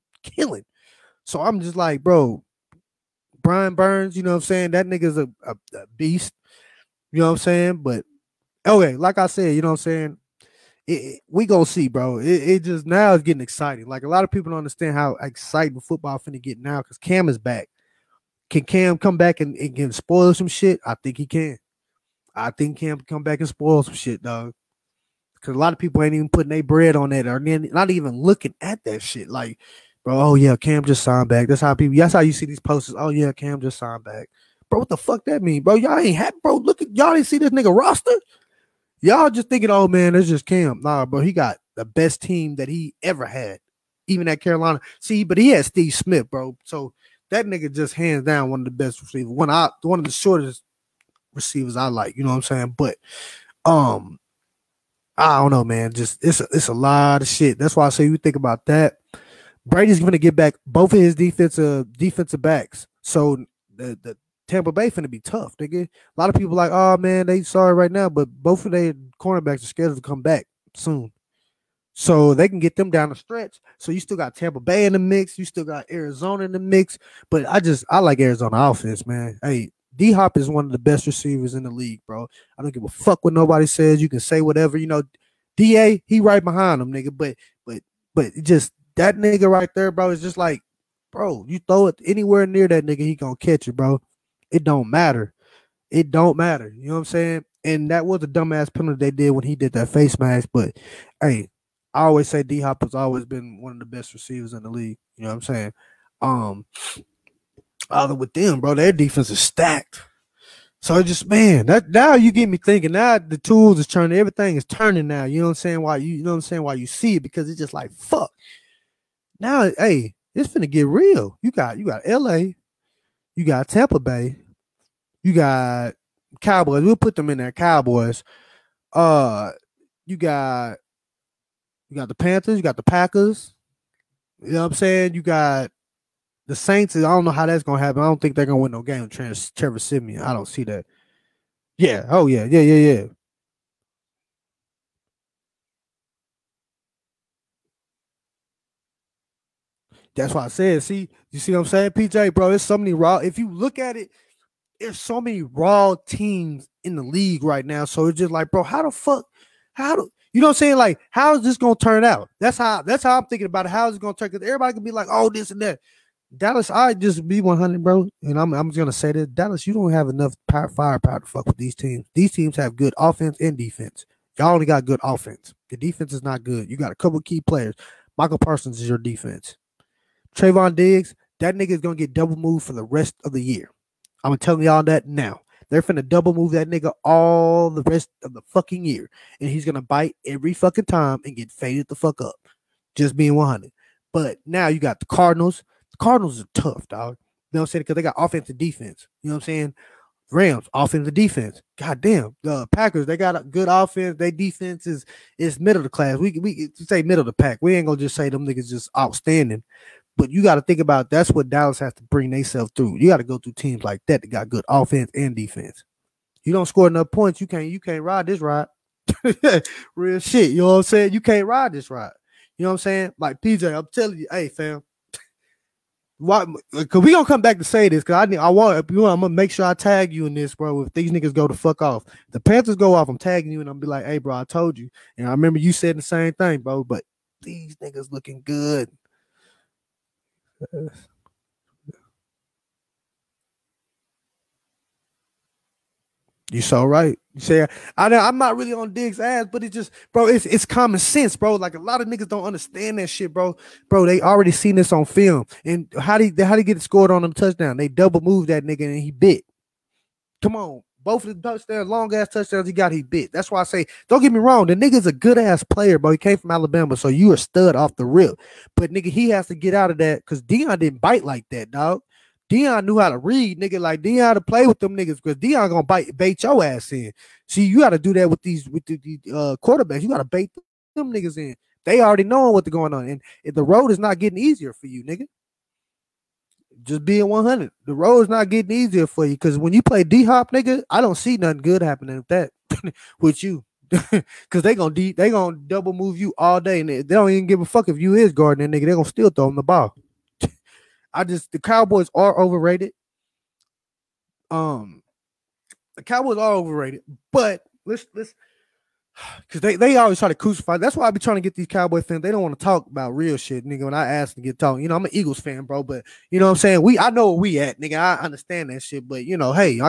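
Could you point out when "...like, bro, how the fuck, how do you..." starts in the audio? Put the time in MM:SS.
02:38.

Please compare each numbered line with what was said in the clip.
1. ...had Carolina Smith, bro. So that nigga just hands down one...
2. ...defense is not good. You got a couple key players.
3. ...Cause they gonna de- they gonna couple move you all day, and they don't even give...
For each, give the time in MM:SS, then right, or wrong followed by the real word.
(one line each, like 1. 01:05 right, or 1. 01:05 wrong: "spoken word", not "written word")
1. 00:45 wrong: "Steve", not "Carolina"
2. 02:55 right
3. 04:54 wrong: "double", not "couple".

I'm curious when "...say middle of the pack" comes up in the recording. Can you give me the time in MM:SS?
03:26.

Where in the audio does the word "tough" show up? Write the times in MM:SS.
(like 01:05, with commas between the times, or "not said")
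01:05, 03:16.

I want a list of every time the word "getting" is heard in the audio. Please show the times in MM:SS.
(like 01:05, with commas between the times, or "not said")
00:13, 04:44, 04:48.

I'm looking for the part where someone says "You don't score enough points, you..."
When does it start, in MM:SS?
03:36.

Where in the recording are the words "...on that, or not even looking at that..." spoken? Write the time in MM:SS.
00:26.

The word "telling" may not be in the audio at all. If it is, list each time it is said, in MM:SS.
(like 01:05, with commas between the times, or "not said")
03:04, 03:43.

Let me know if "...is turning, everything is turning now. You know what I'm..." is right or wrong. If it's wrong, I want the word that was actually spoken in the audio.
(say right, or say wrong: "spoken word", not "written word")
right.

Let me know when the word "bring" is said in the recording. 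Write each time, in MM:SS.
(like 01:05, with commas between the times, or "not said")
03:32.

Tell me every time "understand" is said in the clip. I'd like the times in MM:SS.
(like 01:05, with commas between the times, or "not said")
00:14, 04:12, 05:18.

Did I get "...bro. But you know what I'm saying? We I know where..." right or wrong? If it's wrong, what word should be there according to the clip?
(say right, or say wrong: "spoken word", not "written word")
right.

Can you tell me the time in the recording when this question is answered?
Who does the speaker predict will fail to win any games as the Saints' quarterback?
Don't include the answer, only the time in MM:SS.
02:19.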